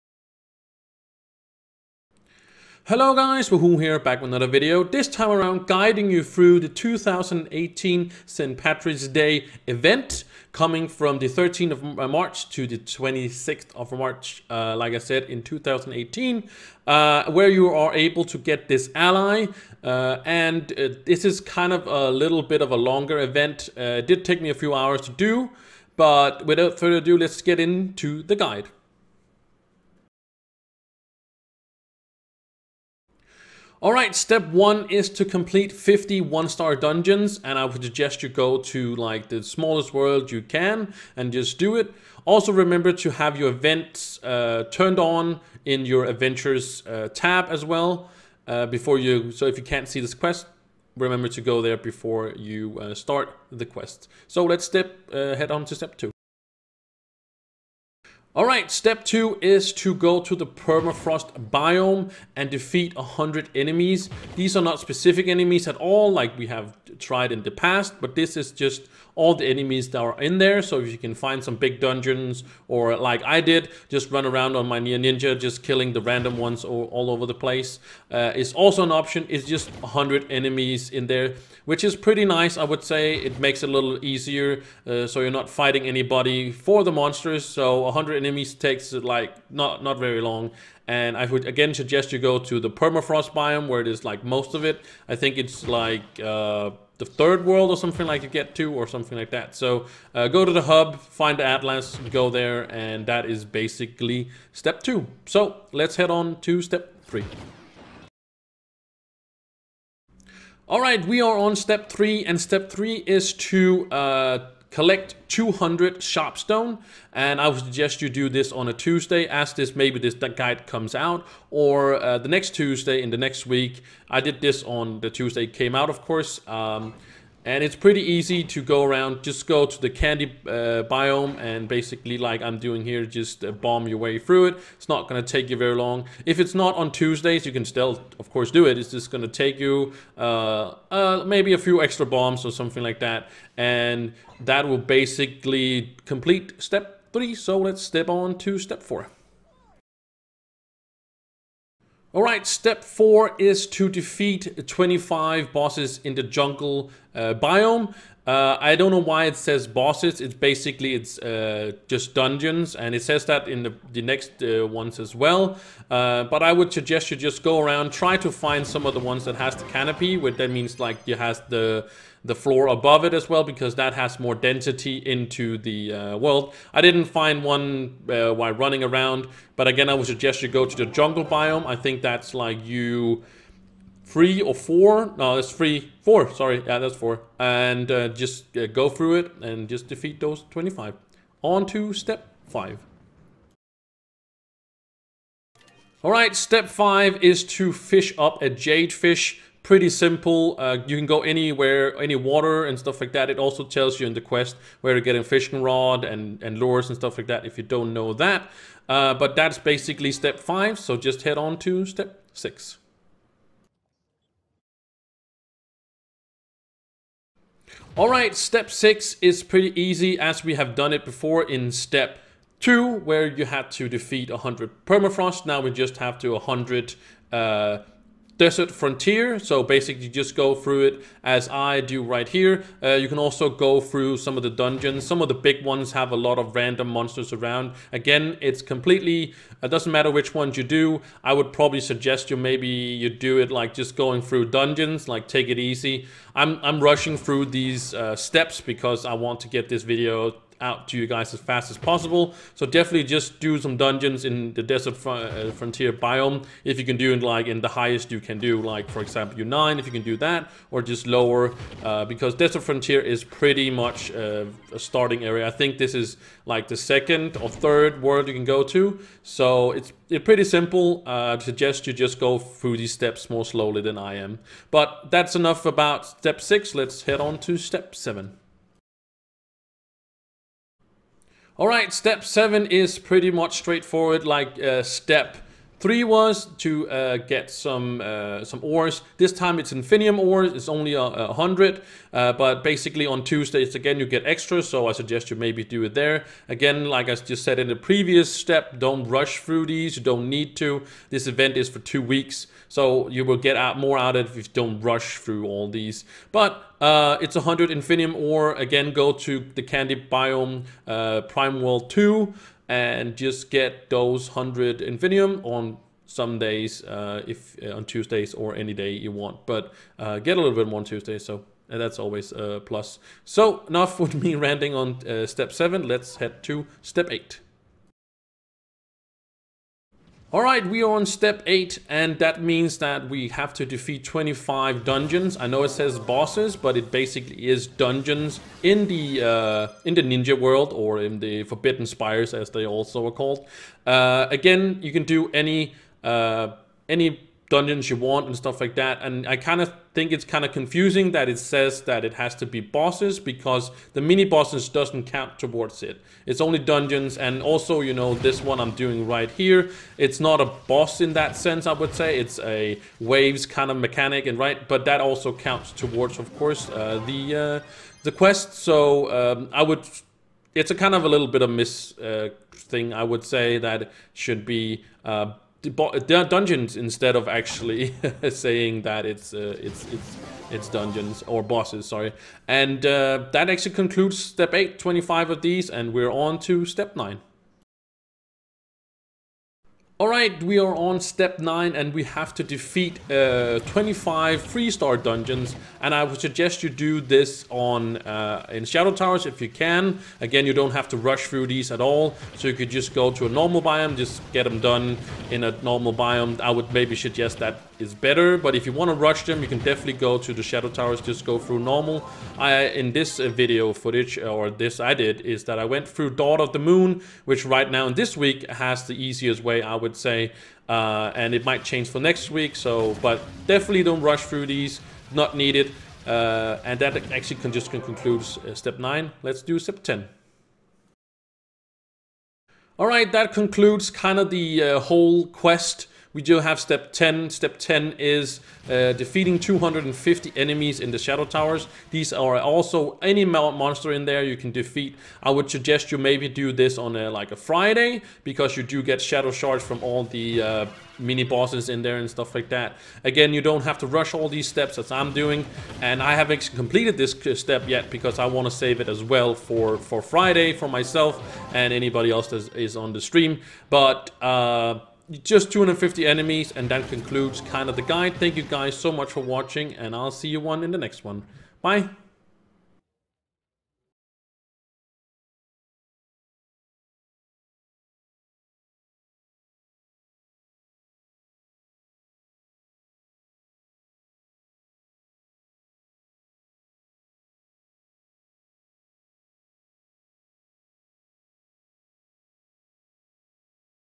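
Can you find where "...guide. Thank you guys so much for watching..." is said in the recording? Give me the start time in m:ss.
7:47.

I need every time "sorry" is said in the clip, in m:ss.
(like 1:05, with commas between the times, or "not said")
3:06, 6:21.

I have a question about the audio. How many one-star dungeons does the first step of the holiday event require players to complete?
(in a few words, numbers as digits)
50.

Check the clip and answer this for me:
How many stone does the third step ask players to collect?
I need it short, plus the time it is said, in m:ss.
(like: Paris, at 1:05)
200, at 1:55.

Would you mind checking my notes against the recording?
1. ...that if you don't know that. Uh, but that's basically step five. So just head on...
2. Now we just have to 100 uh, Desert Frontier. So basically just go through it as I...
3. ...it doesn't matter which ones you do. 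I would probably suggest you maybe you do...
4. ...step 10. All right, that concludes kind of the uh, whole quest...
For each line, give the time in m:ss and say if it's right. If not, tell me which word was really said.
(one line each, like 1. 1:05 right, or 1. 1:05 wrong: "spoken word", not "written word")
1. 3:27 right
2. 3:45 right
3. 3:59 right
4. 7:09 right.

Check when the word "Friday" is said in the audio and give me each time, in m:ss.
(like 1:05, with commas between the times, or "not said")
7:27, 7:40.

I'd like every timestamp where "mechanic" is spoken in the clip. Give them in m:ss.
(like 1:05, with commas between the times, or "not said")
6:03.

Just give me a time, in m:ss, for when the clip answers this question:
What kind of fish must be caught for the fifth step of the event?
3:18.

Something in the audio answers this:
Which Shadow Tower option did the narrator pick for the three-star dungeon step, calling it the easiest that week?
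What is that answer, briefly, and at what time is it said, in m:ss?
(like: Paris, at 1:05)
Dawn of the Moon, at 6:56.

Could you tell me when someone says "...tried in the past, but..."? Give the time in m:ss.
1:06.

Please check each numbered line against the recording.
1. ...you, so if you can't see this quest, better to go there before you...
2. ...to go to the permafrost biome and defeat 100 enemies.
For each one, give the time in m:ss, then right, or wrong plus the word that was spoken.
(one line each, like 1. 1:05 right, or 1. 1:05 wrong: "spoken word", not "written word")
1. 0:48 wrong: "remember", not "better"
2. 0:59 right.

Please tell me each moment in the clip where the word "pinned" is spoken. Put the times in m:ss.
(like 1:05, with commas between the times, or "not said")
not said.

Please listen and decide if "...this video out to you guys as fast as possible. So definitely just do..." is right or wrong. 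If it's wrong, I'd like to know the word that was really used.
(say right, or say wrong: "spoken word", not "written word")
right.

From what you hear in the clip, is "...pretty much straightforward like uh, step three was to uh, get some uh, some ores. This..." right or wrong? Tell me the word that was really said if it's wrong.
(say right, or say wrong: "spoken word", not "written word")
right.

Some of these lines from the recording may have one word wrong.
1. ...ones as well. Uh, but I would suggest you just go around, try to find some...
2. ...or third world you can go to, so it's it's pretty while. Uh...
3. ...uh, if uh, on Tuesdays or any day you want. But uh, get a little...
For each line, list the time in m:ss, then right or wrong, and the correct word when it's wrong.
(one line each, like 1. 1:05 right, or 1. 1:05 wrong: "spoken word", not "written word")
1. 2:44 right
2. 4:27 wrong: "simple", not "while"
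3. 5:16 right.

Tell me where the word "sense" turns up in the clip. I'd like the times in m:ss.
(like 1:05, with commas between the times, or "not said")
6:01.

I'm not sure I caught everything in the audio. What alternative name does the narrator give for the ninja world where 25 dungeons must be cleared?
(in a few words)
Forbidden Spires.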